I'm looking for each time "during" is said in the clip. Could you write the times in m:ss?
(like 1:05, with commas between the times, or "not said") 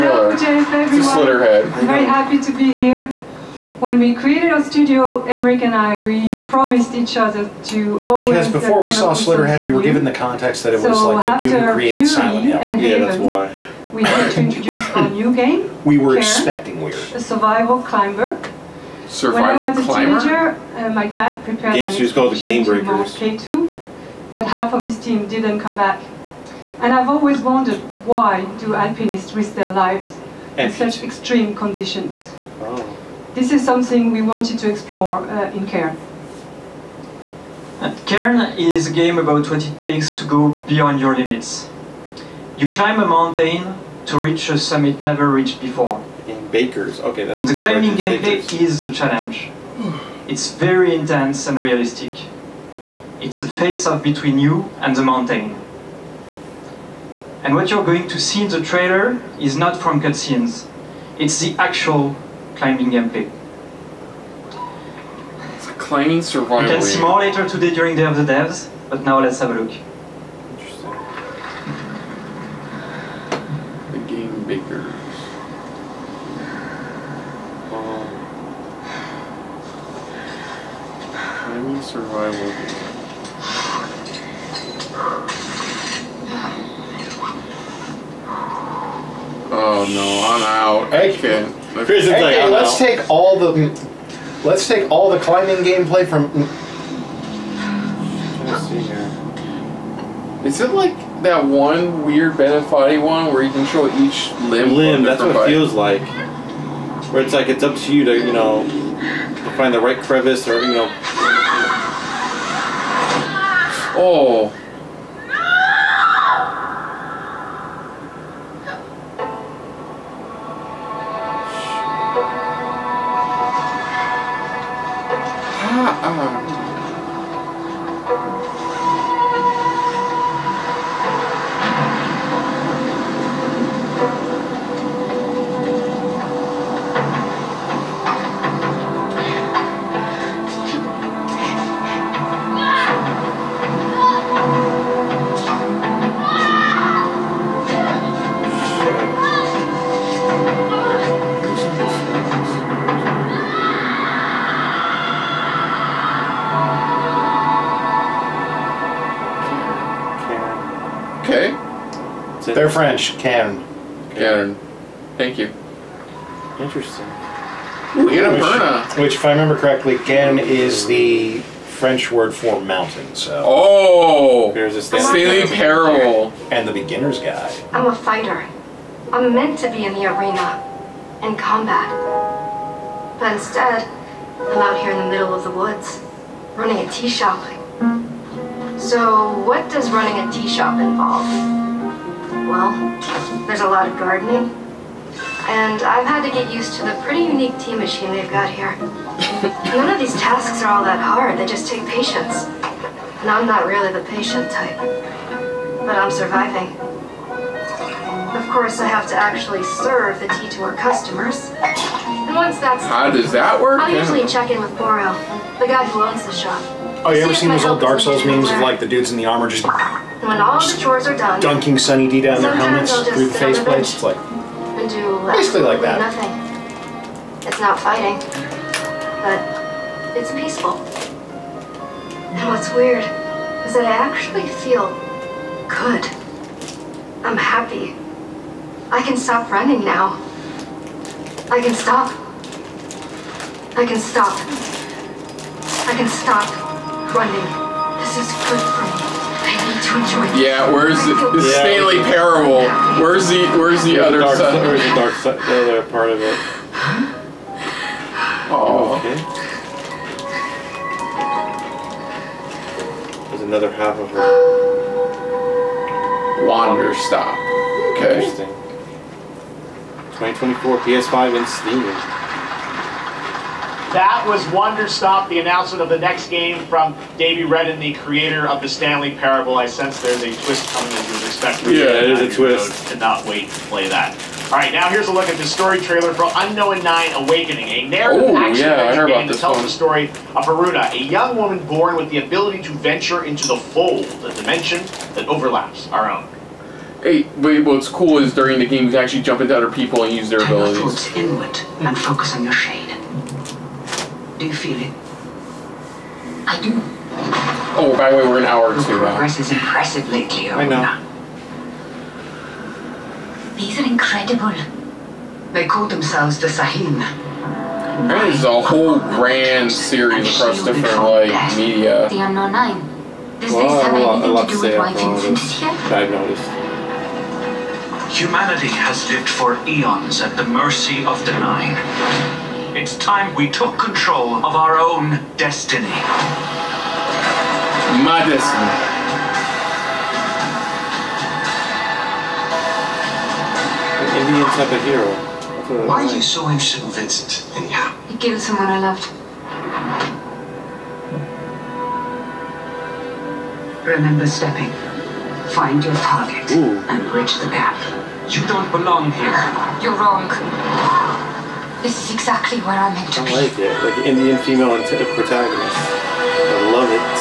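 1:07, 4:58.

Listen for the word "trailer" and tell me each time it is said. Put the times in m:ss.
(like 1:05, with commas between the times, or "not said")
0:58, 4:45.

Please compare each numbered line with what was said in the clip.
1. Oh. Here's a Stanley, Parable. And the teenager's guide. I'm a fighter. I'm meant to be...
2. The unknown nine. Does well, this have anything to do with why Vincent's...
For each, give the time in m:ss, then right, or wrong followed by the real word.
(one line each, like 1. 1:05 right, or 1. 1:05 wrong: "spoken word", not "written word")
1. 2:53 wrong: "beginner", not "teenager"
2. 5:22 right.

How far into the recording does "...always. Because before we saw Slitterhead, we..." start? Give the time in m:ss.
0:08.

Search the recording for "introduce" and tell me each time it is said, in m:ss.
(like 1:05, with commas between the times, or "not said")
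0:14.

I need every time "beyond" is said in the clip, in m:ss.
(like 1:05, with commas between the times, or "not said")
0:40.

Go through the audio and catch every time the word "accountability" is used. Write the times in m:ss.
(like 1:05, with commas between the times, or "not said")
not said.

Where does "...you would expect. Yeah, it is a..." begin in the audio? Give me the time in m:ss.
4:41.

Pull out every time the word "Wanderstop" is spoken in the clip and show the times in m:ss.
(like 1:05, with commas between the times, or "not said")
4:26, 4:34.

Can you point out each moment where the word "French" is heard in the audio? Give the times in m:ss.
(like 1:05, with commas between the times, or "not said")
2:42, 2:51.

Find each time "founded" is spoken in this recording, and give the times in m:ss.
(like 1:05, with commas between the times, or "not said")
not said.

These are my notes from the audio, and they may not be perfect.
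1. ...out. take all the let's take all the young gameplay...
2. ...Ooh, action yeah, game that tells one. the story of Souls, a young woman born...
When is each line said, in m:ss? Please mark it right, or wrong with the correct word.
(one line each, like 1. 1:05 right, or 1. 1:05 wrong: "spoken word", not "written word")
1. 1:32 wrong: "climbing", not "young"
2. 4:48 wrong: "Haroona", not "Souls".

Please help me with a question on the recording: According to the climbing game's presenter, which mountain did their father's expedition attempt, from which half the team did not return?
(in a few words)
K2.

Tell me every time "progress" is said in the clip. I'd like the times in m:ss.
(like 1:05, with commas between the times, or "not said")
5:09.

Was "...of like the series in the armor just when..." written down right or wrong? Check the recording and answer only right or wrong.
wrong.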